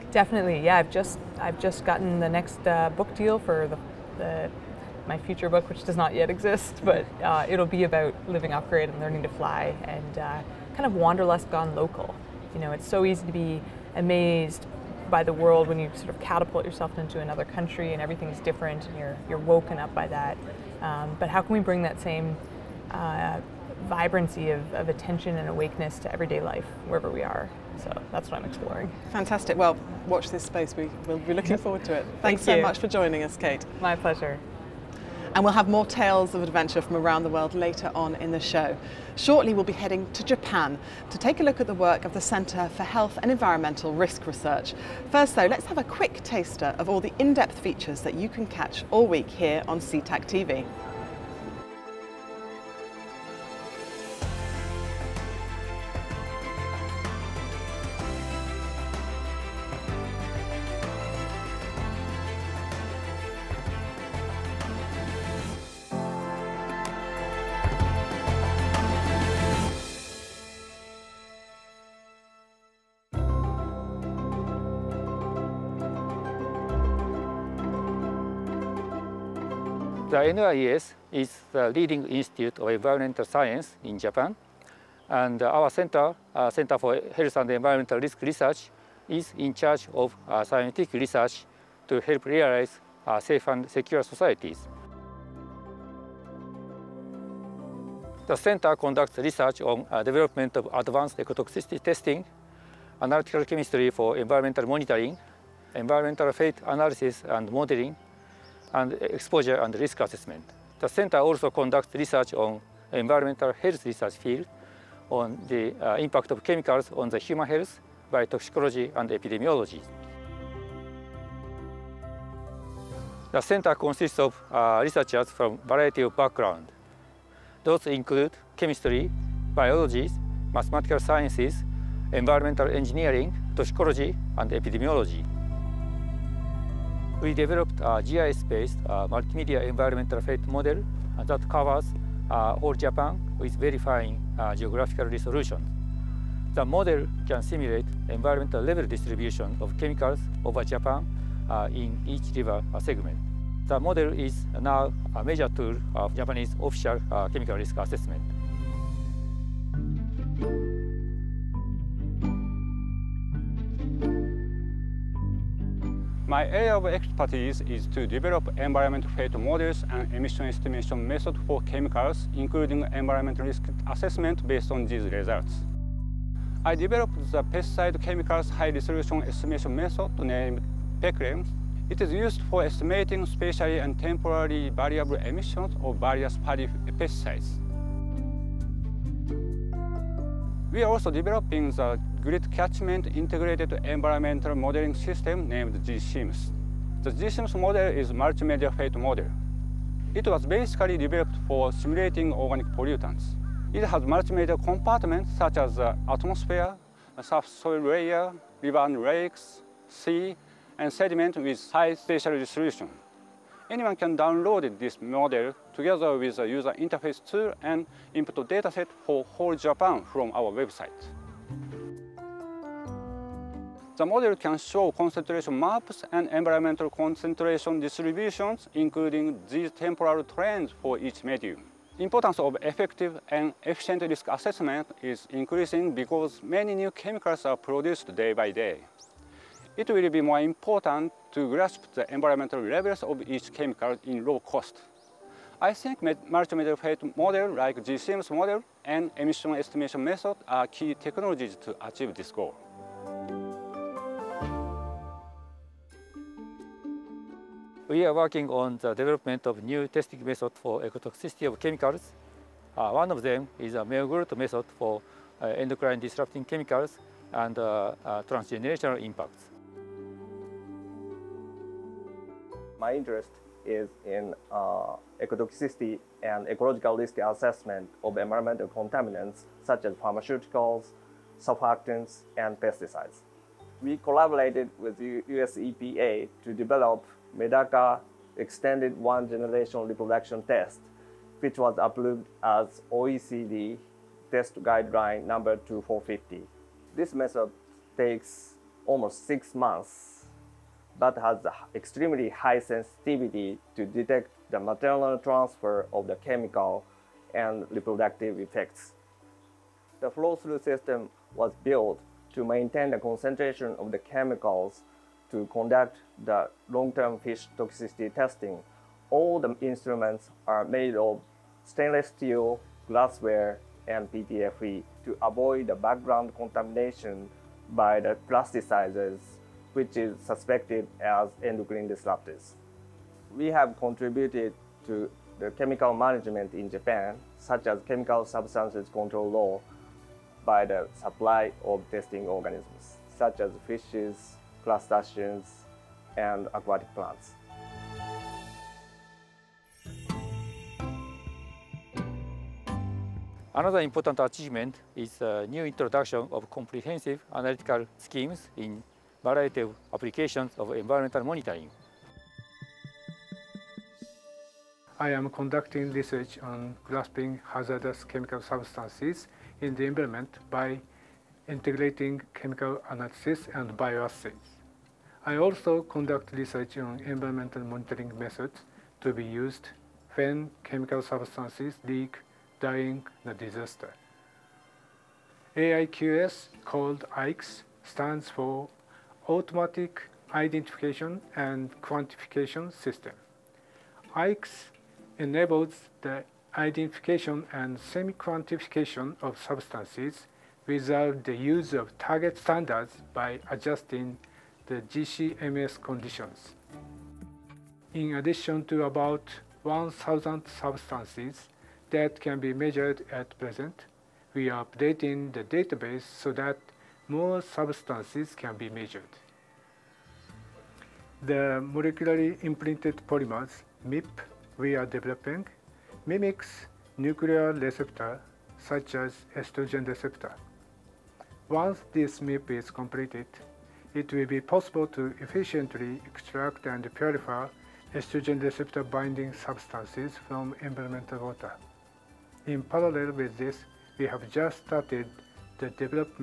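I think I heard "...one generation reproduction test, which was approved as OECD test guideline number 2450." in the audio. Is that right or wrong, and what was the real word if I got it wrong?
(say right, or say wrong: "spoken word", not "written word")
right.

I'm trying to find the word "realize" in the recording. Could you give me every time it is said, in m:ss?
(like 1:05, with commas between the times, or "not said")
1:32.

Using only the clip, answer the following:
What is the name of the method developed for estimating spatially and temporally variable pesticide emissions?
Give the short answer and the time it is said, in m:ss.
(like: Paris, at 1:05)
PeCHREM, at 3:01.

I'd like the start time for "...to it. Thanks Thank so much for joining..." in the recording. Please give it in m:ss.
0:31.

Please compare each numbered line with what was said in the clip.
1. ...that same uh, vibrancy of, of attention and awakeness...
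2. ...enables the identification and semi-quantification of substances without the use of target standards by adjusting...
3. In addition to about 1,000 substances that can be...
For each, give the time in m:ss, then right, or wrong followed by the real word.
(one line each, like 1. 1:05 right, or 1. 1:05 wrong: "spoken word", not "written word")
1. 0:21 right
2. 6:35 right
3. 6:47 right.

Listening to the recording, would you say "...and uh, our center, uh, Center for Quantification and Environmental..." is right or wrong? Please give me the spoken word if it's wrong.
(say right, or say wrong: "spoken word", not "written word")
wrong: "Health", not "Quantification".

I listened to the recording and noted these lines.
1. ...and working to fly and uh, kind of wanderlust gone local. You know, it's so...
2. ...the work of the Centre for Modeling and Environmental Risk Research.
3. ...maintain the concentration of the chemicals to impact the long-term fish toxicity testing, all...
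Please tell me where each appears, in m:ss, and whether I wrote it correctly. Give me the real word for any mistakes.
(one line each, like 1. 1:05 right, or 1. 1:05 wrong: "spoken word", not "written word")
1. 0:08 wrong: "learning", not "working"
2. 0:41 wrong: "Health", not "Modeling"
3. 5:12 wrong: "conduct", not "impact".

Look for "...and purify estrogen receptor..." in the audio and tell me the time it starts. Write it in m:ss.
7:16.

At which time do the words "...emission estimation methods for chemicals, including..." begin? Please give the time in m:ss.
2:50.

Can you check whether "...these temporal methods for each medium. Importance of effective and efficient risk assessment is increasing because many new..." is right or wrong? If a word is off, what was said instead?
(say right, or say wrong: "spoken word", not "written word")
wrong: "trends", not "methods".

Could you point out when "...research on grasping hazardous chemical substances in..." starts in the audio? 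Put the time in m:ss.
6:05.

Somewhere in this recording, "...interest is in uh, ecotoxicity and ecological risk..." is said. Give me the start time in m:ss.
4:32.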